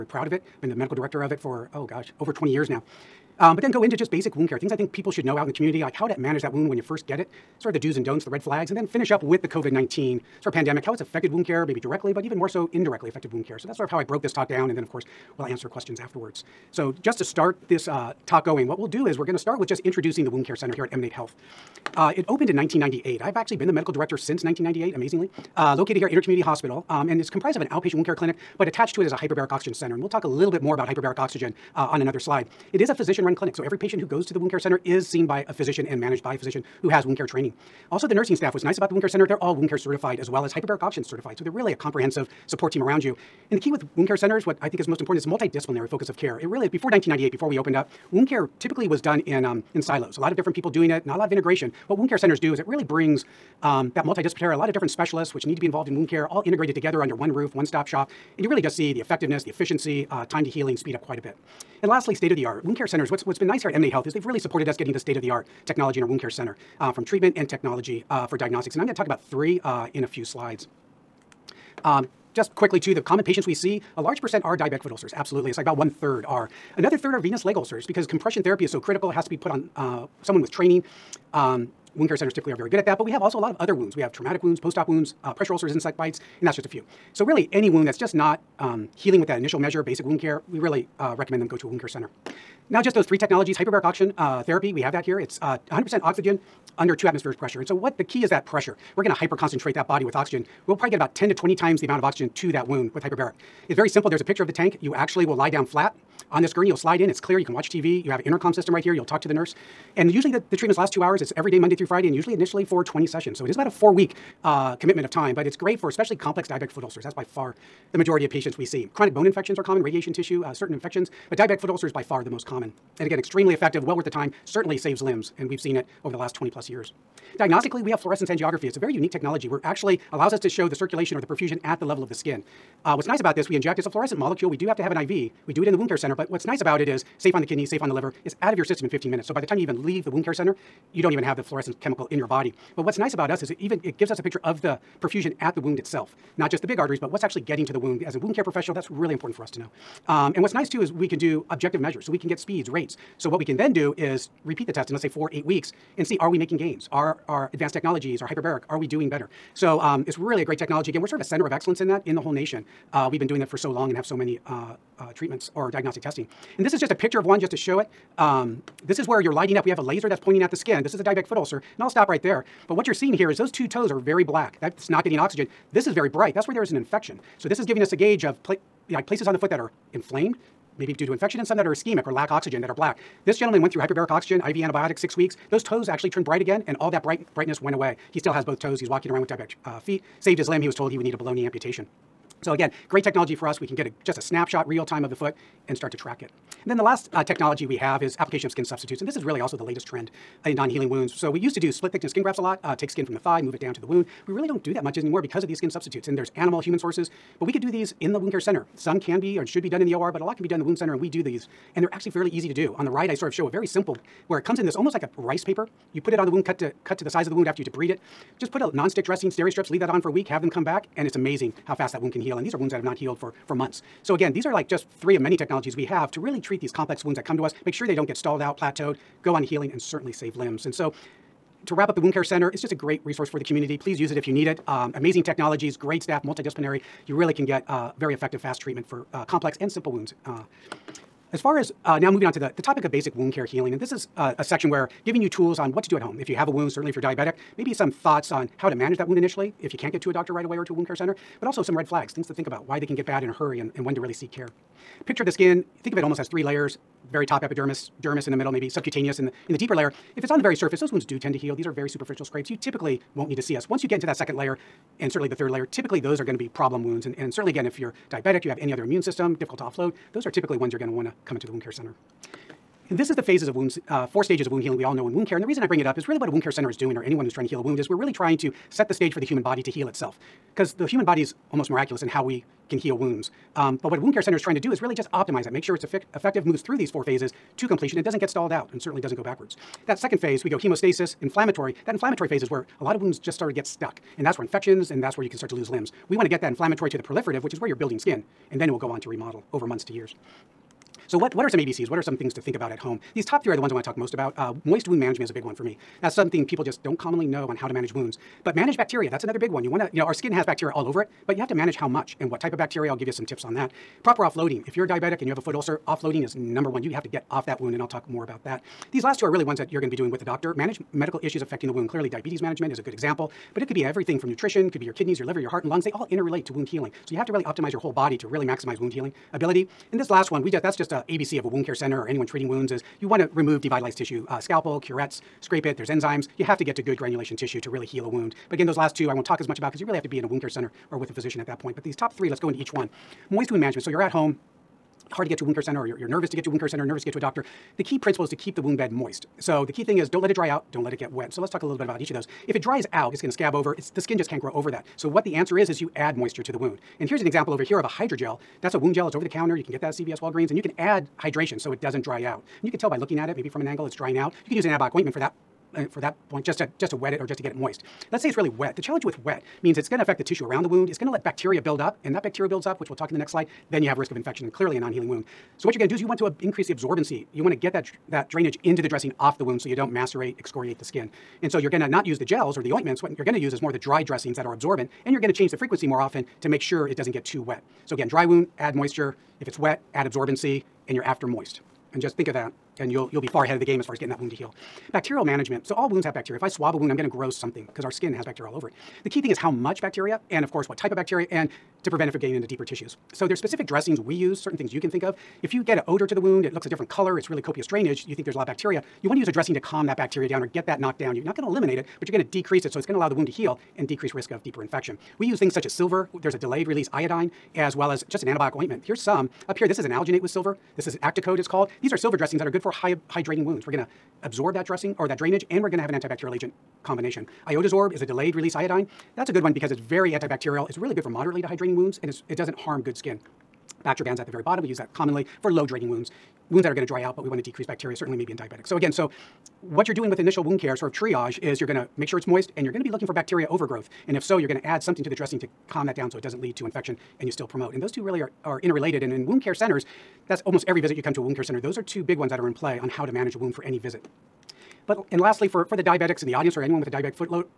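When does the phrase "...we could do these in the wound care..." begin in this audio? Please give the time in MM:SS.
03:27.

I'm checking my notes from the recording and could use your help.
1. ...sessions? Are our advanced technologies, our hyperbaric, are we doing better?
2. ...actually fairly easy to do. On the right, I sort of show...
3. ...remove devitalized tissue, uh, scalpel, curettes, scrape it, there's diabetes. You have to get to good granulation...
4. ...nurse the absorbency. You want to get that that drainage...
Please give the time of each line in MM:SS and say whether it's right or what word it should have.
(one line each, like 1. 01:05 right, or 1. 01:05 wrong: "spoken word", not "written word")
1. 02:36 wrong: "gains", not "sessions"
2. 03:31 right
3. 05:33 wrong: "enzymes", not "diabetes"
4. 06:16 wrong: "increase", not "nurse".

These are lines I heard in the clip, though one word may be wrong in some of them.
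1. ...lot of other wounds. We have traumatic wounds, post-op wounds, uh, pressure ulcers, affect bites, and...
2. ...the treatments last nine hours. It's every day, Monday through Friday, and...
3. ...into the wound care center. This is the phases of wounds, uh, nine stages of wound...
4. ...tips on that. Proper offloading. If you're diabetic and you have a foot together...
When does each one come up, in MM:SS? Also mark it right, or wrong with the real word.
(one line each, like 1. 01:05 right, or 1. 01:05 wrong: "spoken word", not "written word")
1. 01:23 wrong: "insect", not "affect"
2. 01:50 wrong: "two", not "nine"
3. 04:31 wrong: "four", not "nine"
4. 05:13 wrong: "ulcer", not "together".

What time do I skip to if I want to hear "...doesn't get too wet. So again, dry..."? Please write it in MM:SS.
06:26.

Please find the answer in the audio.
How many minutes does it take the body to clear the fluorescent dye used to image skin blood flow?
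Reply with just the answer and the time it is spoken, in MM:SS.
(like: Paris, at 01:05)
15 minutes, at 02:18.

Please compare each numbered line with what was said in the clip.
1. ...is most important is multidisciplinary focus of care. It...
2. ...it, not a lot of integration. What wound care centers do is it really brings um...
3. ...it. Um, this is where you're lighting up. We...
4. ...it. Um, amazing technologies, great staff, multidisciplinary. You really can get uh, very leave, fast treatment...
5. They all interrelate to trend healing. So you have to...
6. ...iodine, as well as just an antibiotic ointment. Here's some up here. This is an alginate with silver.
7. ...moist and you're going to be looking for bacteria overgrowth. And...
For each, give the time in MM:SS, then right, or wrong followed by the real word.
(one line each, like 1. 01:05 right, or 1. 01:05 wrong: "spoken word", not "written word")
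1. 00:44 right
2. 00:50 right
3. 02:47 right
4. 03:54 wrong: "effective", not "leave"
5. 05:25 wrong: "wound", not "trend"
6. 06:56 right
7. 07:22 right.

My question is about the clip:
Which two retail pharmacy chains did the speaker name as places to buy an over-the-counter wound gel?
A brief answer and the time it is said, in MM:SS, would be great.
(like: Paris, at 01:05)
CVS, Walgreens, at 05:59.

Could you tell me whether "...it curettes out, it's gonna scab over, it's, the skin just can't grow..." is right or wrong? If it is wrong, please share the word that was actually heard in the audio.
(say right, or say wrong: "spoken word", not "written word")
wrong: "dries", not "curettes".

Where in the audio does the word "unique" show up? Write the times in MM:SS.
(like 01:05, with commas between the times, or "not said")
02:08.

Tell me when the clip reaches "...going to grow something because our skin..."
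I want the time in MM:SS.
06:36.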